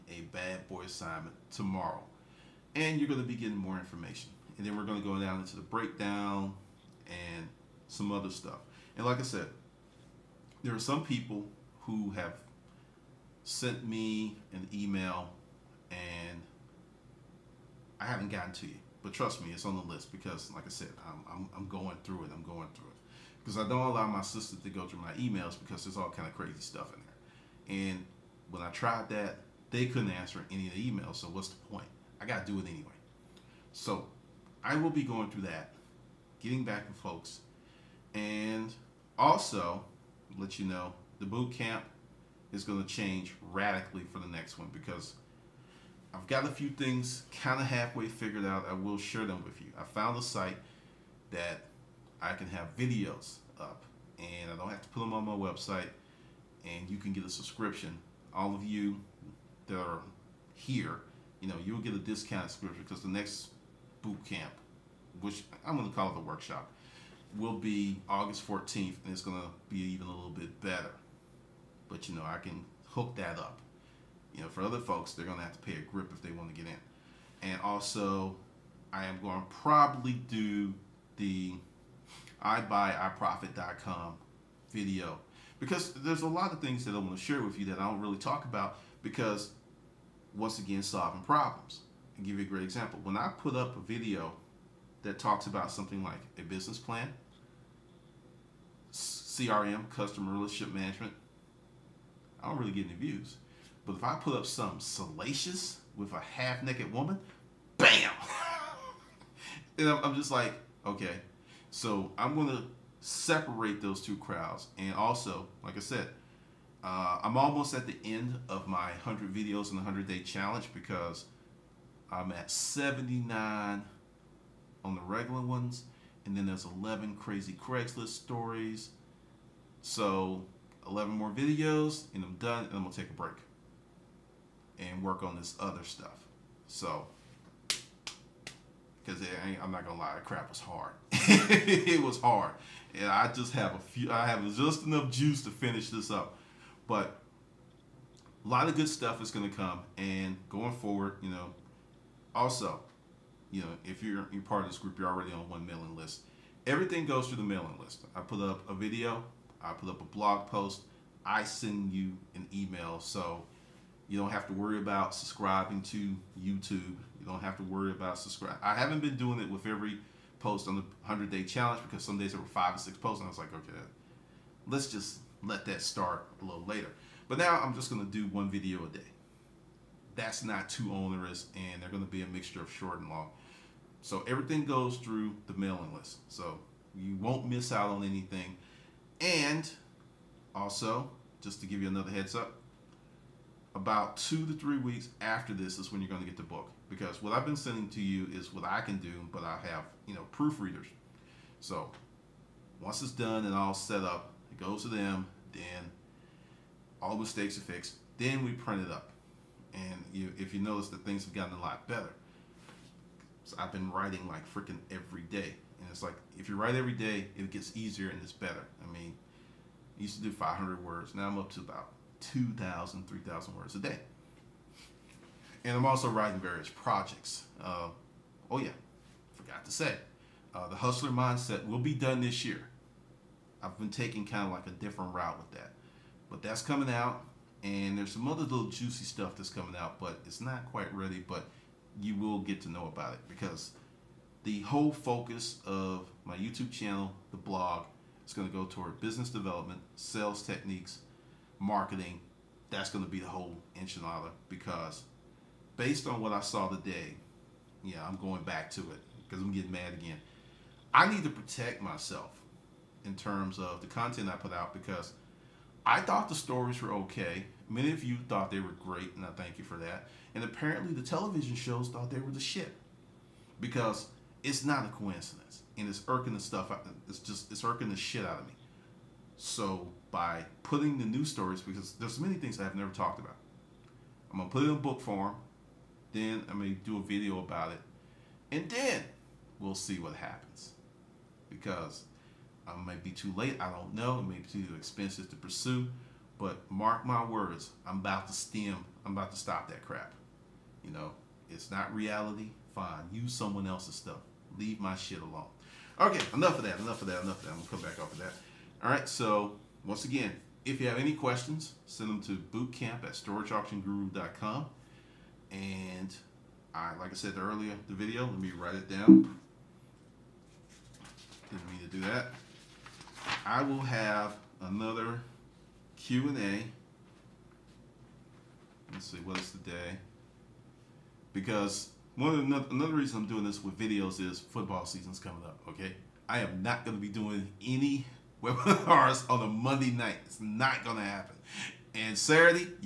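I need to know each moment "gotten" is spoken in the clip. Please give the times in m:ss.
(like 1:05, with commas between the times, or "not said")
0:18, 3:31.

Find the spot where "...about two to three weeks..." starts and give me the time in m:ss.
3:13.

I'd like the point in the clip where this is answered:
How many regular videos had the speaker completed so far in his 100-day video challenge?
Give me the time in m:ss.
2:02.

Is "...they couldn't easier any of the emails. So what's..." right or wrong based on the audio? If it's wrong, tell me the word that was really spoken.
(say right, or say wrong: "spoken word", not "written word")
wrong: "answer", not "easier".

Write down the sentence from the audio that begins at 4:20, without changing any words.
I need to protect myself in terms of the content I put out because I thought the stories were okay.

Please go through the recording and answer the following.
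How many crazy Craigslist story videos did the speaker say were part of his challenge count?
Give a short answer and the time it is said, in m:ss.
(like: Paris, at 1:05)
11, at 2:06.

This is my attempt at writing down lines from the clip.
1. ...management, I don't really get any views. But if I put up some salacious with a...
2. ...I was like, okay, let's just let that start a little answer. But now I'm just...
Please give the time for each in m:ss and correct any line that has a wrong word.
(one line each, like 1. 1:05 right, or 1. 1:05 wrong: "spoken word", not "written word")
1. 1:40 right
2. 2:53 wrong: "later", not "answer".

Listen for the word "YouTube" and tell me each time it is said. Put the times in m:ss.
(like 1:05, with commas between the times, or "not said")
2:46, 4:06.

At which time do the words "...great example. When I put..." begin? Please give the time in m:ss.
1:32.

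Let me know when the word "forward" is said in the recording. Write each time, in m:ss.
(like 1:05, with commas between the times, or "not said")
2:30.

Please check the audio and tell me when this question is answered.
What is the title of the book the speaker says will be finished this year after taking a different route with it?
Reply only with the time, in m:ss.
3:50.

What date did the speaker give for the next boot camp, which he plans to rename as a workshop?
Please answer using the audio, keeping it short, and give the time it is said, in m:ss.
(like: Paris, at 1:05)
August 14th, at 1:08.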